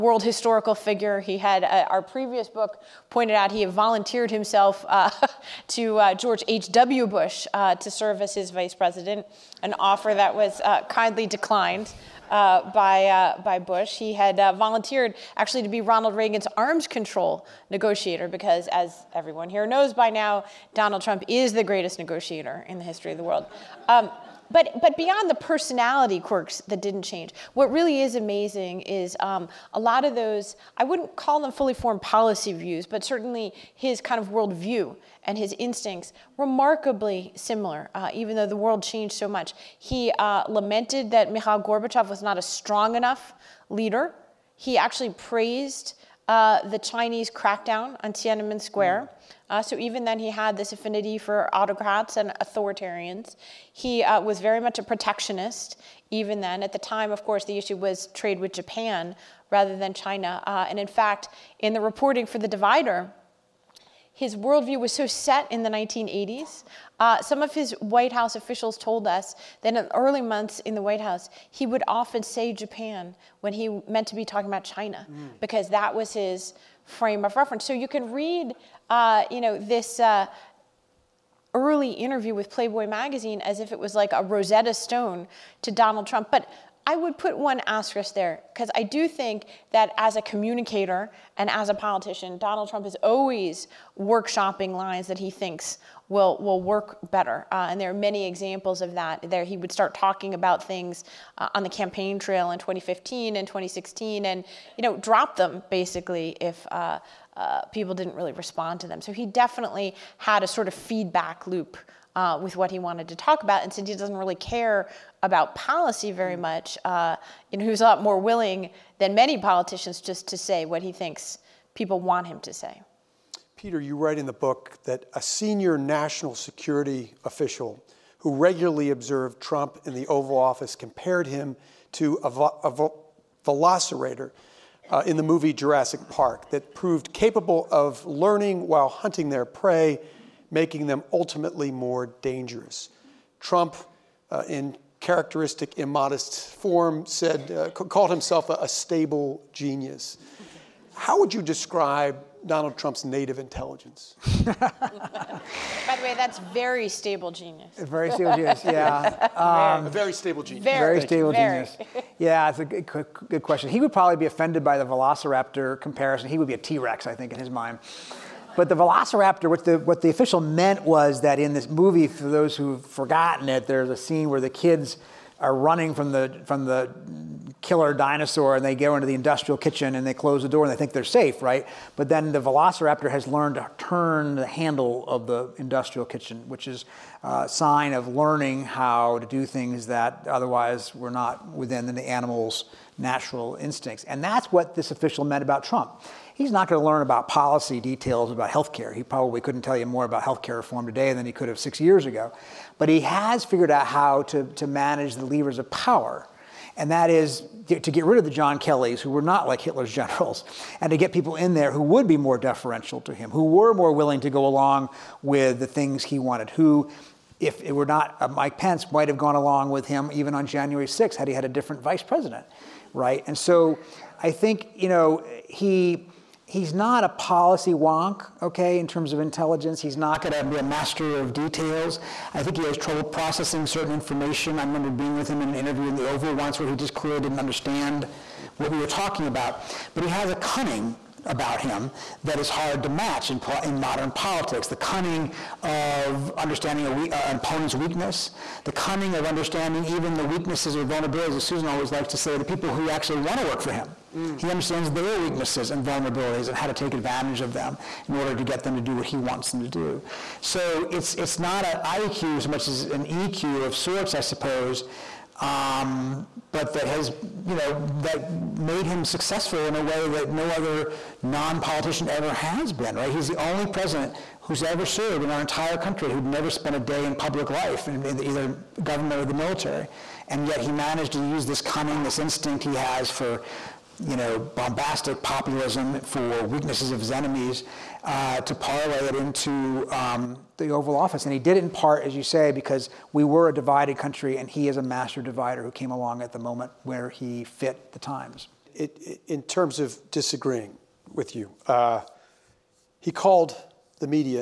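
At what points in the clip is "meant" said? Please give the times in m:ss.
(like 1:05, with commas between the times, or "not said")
1:13, 2:50, 3:15.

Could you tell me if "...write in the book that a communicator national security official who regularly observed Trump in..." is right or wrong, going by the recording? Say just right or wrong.
wrong.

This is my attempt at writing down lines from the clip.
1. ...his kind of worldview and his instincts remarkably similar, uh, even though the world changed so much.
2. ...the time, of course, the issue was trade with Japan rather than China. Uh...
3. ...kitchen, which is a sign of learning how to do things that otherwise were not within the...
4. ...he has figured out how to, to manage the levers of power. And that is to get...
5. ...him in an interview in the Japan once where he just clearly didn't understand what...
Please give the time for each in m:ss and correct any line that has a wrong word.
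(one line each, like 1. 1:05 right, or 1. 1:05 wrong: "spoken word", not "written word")
1. 0:33 right
2. 0:56 right
3. 3:06 right
4. 3:22 right
5. 3:55 wrong: "Oval", not "Japan".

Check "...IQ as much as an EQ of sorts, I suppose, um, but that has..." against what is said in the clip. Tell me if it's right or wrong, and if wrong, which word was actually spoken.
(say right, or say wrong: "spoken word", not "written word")
right.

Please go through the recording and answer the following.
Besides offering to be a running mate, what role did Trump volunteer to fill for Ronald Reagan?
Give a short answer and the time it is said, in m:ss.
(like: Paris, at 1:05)
Arms control negotiator, at 0:16.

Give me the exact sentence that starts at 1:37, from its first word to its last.
Uh, and there are many examples of that.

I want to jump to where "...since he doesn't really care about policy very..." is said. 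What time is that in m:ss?
1:53.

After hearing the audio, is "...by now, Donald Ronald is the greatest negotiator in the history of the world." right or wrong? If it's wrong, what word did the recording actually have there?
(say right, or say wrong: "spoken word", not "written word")
wrong: "Trump", not "Ronald".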